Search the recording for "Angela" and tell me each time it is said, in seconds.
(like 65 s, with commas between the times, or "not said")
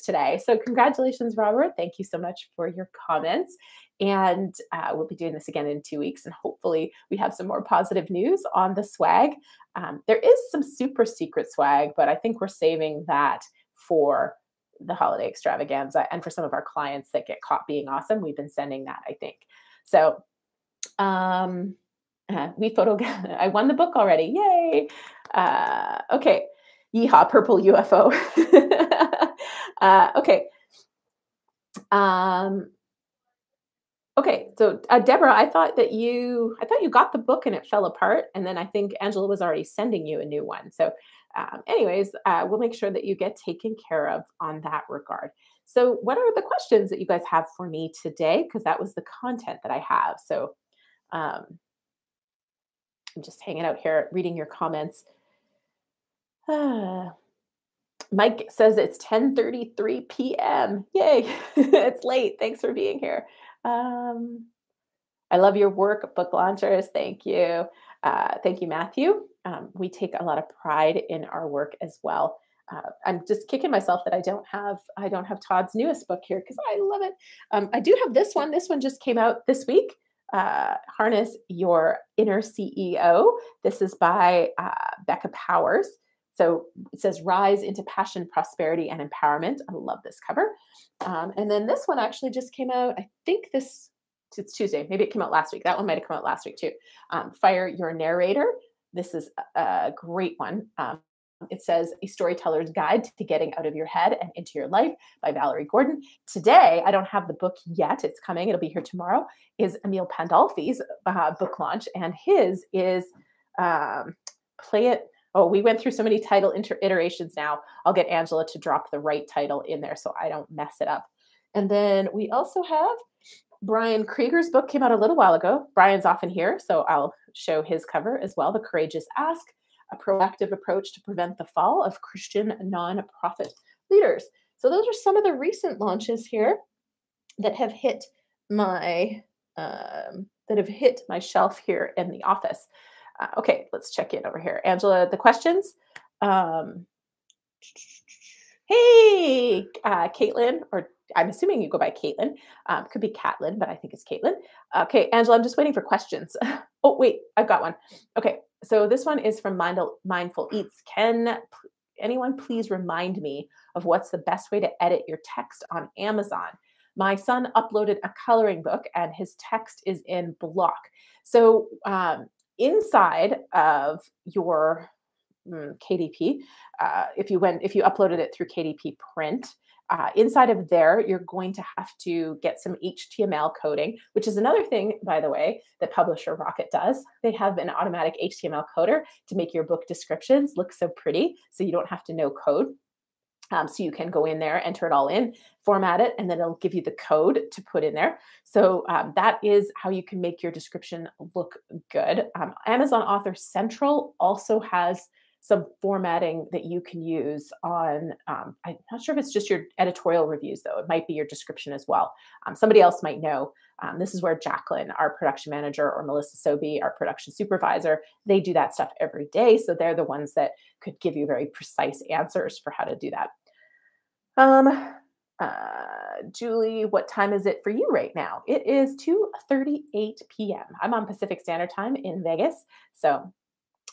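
39 s, 118 s, 144 s, 155 s.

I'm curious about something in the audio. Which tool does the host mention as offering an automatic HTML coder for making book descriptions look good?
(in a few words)
Publisher Rocket.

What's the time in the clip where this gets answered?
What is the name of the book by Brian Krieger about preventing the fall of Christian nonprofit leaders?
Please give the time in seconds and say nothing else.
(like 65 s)
128 s.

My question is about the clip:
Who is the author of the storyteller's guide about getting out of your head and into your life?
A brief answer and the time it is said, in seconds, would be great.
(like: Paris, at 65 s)
Valerie Gordon, at 105 s.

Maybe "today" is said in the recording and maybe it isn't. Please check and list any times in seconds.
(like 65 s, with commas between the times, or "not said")
0 s, 48 s, 106 s.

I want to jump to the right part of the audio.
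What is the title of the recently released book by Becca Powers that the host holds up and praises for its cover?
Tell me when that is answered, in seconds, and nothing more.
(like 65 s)
80 s.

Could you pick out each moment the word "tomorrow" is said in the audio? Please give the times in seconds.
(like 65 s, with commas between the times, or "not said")
108 s.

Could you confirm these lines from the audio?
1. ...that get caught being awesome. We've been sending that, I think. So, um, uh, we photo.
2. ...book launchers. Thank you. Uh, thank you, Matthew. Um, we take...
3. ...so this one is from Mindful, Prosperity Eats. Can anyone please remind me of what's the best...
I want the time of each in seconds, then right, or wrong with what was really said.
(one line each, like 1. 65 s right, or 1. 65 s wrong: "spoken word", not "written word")
1. 17 s right
2. 66 s right
3. 158 s wrong: "Mindful", not "Prosperity".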